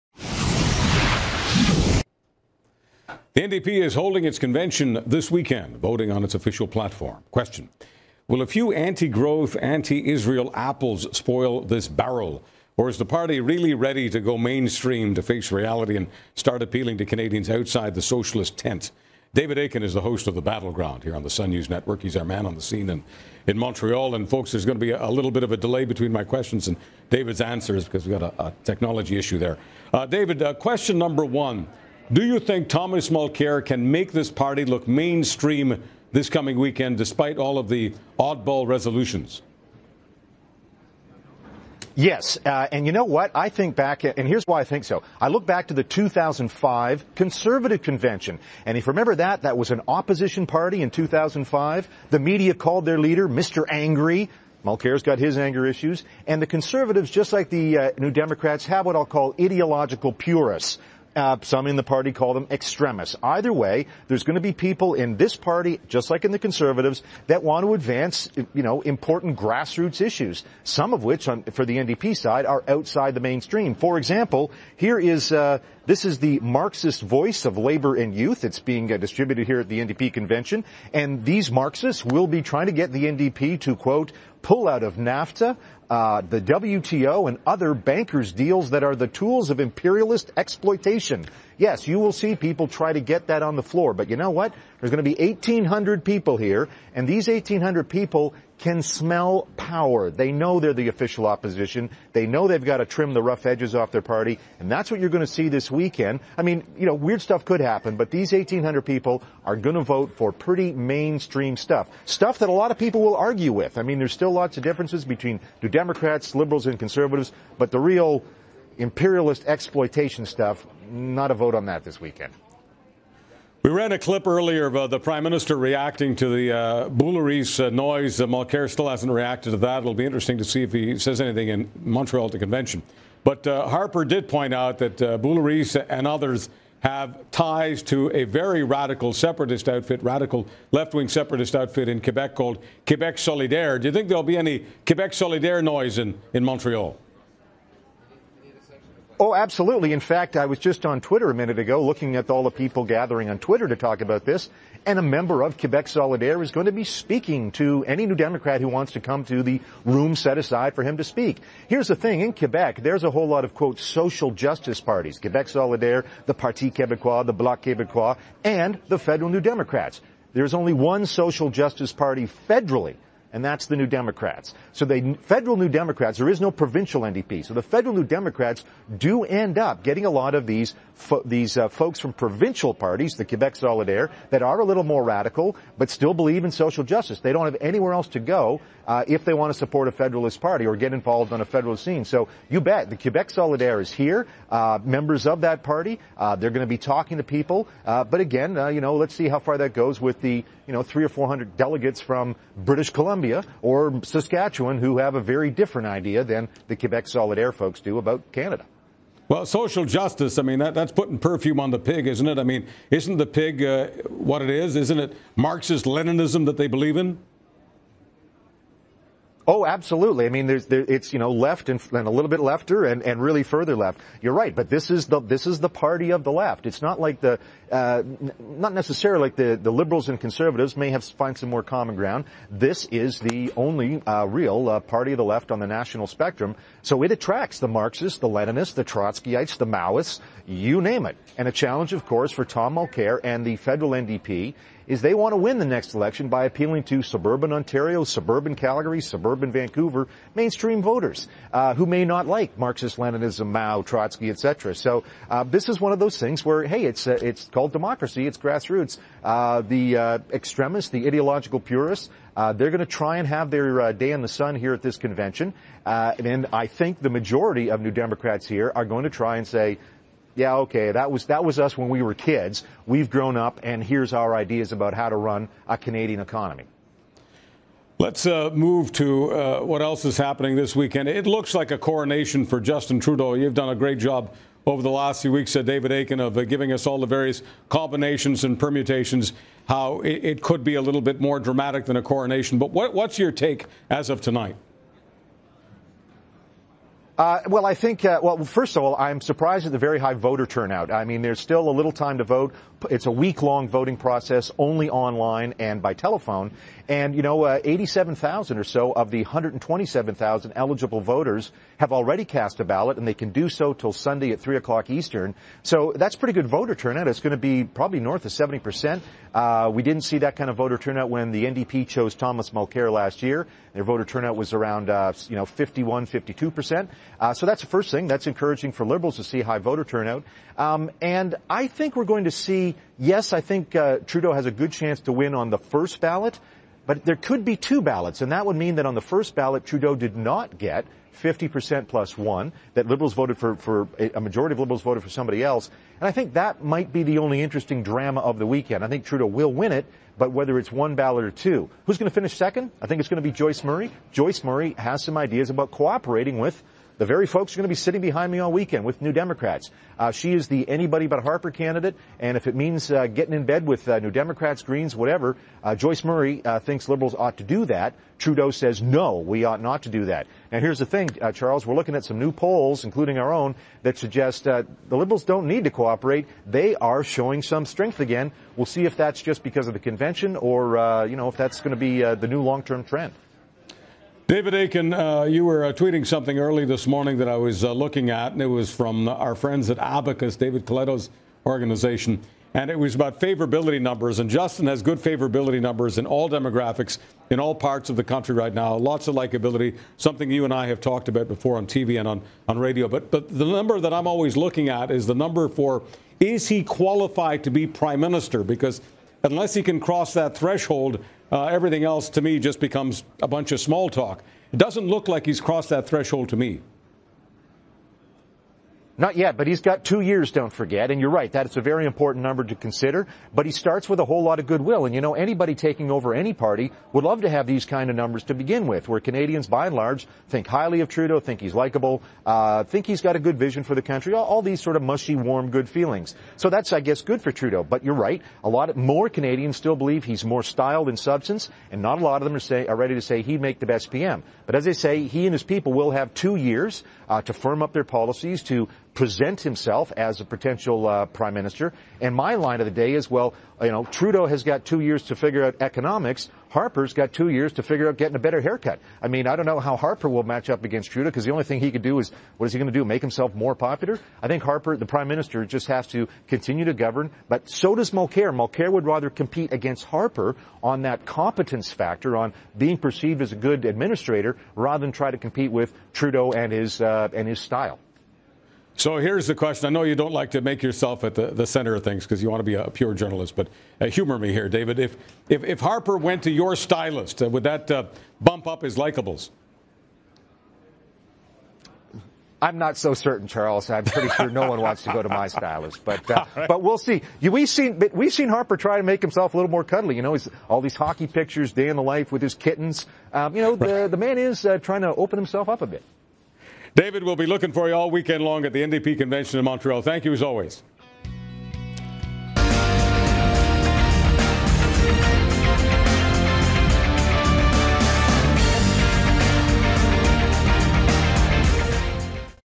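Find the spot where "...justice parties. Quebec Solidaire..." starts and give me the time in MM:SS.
02:44.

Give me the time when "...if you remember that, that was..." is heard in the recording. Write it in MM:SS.
00:48.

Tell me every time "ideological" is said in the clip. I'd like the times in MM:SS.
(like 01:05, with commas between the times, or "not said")
00:59, 04:21.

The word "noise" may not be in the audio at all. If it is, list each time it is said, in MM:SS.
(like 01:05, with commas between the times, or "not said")
02:07, 02:25.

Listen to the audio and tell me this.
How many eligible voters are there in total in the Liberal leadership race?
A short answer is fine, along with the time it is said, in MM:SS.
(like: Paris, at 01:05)
127,000, at 05:09.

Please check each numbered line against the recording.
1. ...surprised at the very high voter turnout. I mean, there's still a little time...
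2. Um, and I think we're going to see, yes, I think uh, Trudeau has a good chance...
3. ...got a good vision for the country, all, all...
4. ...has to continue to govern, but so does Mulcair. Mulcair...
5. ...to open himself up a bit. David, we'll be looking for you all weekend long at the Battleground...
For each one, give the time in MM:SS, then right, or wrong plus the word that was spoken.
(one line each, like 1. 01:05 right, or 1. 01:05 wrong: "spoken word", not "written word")
1. 04:59 right
2. 05:30 right
3. 07:13 right
4. 07:45 right
5. 08:24 wrong: "NDP", not "Battleground".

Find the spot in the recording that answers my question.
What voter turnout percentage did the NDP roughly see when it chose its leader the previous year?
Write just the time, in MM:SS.
05:25.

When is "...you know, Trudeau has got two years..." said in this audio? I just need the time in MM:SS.
07:33.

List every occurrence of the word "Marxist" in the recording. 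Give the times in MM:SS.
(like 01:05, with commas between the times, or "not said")
01:16, 01:21, 03:35, 03:57, 04:12.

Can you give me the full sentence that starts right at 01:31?
Yes, you will see people try to get that on the floor, but you know what?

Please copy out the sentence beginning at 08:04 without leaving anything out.
If, if, if Harper went to your stylist, uh, would that uh, bump up his likables?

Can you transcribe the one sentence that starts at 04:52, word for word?
But what, what's your take as of tonight?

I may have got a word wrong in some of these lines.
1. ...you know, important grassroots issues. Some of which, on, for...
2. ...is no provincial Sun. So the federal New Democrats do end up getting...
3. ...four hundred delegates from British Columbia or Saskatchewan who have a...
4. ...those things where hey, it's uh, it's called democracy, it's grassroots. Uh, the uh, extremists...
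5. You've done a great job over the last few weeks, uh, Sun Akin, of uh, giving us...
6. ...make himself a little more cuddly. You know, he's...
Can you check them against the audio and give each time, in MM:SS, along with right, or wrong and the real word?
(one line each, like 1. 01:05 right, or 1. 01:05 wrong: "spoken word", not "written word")
1. 01:08 right
2. 02:56 wrong: "NDP", not "Sun"
3. 03:21 right
4. 04:15 right
5. 04:43 wrong: "David", not "Sun"
6. 08:18 right.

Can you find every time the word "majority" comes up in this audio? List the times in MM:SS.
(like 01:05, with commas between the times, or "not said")
04:27, 05:44.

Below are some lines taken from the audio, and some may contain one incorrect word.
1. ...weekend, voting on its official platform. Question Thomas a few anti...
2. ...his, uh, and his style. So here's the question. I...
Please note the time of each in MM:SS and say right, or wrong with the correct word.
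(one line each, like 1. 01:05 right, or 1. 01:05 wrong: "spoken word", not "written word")
1. 00:05 wrong: "Will", not "Thomas"
2. 07:56 right.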